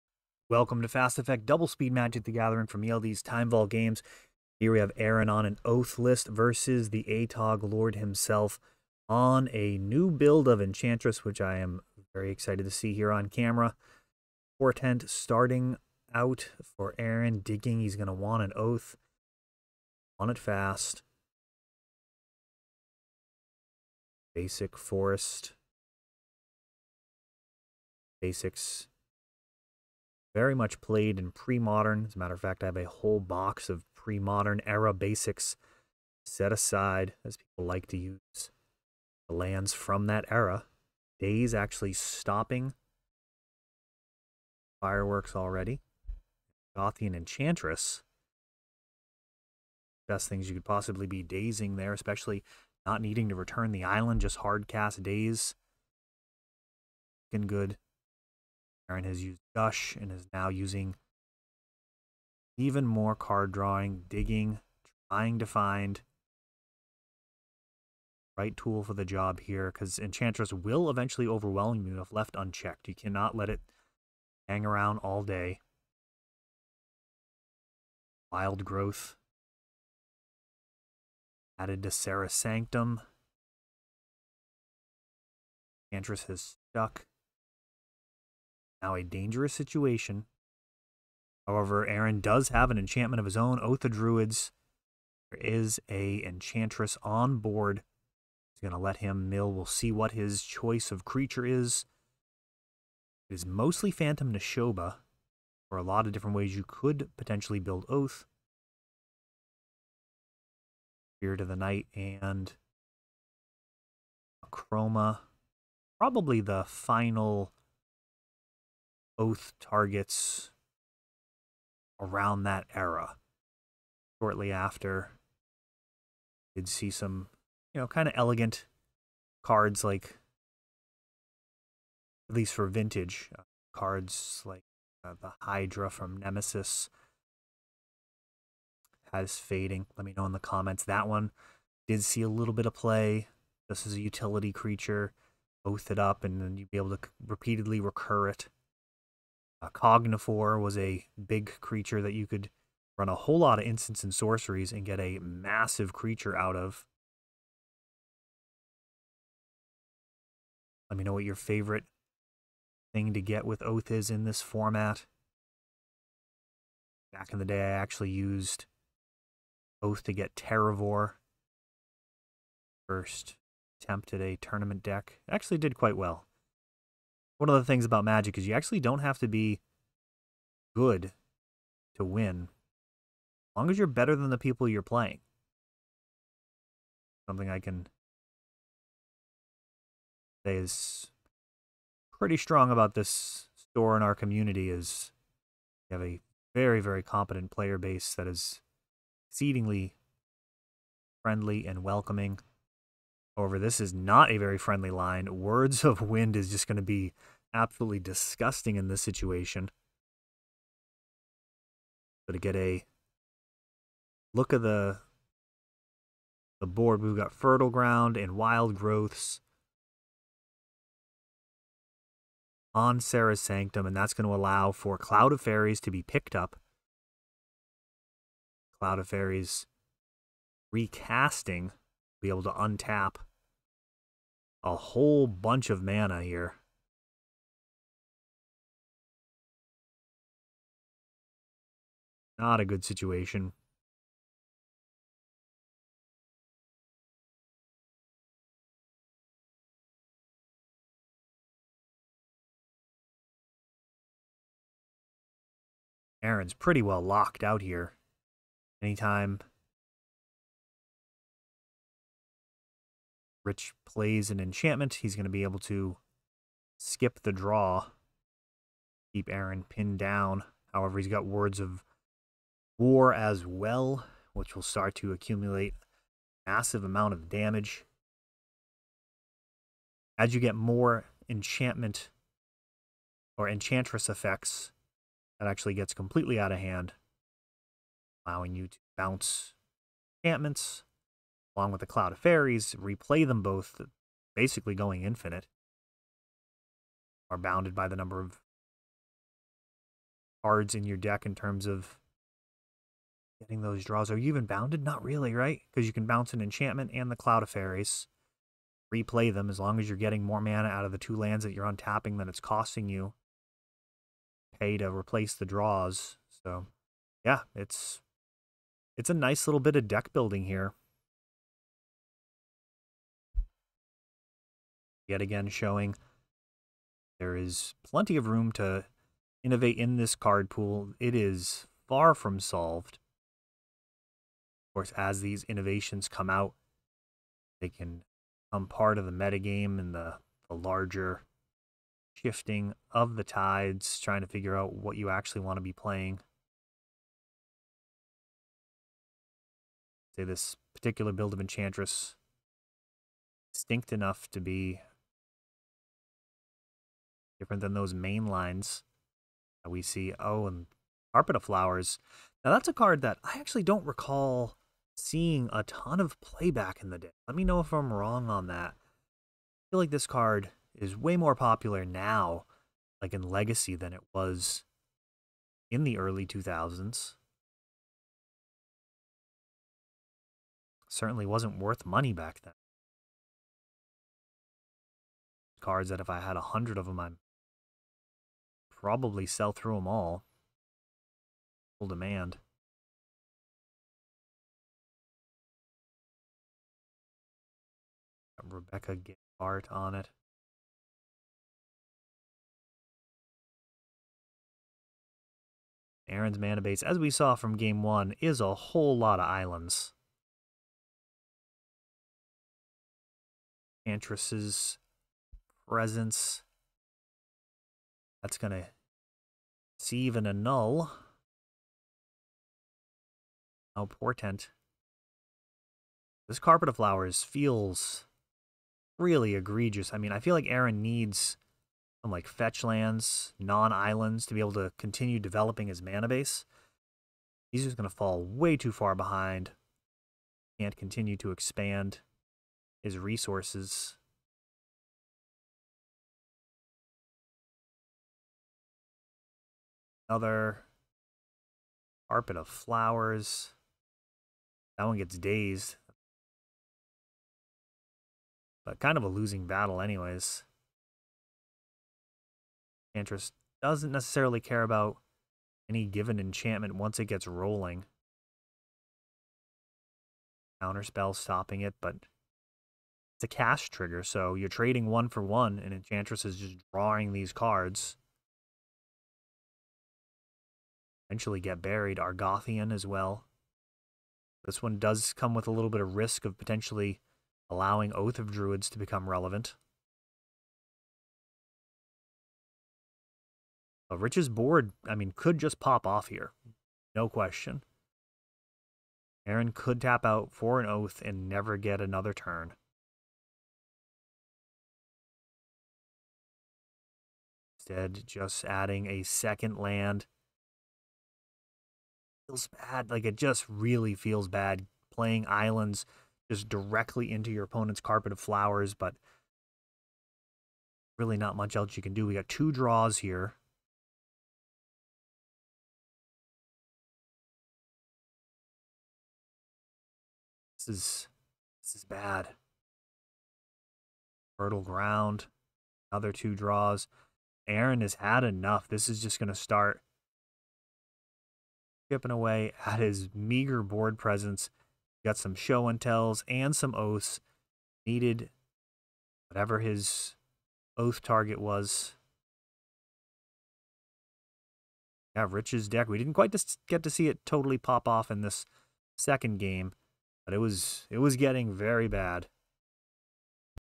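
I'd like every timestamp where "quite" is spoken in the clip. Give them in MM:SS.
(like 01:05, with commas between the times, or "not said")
02:55, 09:16.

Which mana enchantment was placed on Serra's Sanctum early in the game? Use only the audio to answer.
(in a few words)
Wild Growth.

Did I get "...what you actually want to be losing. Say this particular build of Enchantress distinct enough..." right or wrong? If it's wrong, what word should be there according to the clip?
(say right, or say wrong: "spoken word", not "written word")
wrong: "playing", not "losing".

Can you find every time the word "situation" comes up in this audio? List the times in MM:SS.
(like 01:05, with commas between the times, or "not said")
01:29, 03:29, 04:02.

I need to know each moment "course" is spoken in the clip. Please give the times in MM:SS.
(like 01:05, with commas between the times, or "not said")
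05:34.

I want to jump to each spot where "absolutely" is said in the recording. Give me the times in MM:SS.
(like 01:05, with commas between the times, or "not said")
03:27.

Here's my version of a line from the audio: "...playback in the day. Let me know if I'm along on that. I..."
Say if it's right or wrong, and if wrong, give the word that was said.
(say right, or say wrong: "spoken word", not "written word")
wrong: "wrong", not "along".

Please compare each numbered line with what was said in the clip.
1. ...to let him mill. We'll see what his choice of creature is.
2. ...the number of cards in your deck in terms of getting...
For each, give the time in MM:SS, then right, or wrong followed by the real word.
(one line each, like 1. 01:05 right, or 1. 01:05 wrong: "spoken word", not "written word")
1. 01:38 right
2. 04:57 right.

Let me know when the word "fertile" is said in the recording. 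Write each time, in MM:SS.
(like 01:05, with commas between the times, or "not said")
03:37, 08:54.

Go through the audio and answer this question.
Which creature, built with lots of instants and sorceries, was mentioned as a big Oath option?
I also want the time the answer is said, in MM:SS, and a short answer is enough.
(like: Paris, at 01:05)
Cognivore, at 02:29.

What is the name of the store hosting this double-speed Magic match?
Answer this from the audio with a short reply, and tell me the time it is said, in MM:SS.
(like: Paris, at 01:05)
ELD's Time Vault Games, at 00:02.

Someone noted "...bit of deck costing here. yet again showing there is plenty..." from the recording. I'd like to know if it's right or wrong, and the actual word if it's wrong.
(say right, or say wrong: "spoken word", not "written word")
wrong: "building", not "costing".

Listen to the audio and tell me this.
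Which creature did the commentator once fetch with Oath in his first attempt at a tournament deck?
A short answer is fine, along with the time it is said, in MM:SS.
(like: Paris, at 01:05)
Terravore, at 02:50.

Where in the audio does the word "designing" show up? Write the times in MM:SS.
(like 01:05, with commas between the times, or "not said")
not said.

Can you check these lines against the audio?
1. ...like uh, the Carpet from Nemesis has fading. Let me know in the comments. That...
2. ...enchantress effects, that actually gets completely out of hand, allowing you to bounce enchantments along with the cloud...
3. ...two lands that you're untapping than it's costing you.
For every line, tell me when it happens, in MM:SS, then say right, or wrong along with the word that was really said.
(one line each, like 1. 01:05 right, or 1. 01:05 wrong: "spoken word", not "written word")
1. 02:14 wrong: "Hydra", not "Carpet"
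2. 04:43 right
3. 05:10 right.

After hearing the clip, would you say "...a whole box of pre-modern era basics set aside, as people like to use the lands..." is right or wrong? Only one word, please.
right.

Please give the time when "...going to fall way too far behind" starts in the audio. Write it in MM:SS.
07:17.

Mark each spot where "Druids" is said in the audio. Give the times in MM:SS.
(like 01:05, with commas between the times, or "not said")
01:33, 08:08.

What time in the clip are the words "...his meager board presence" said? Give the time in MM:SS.
09:02.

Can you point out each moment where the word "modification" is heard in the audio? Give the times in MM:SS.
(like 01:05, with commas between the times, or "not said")
not said.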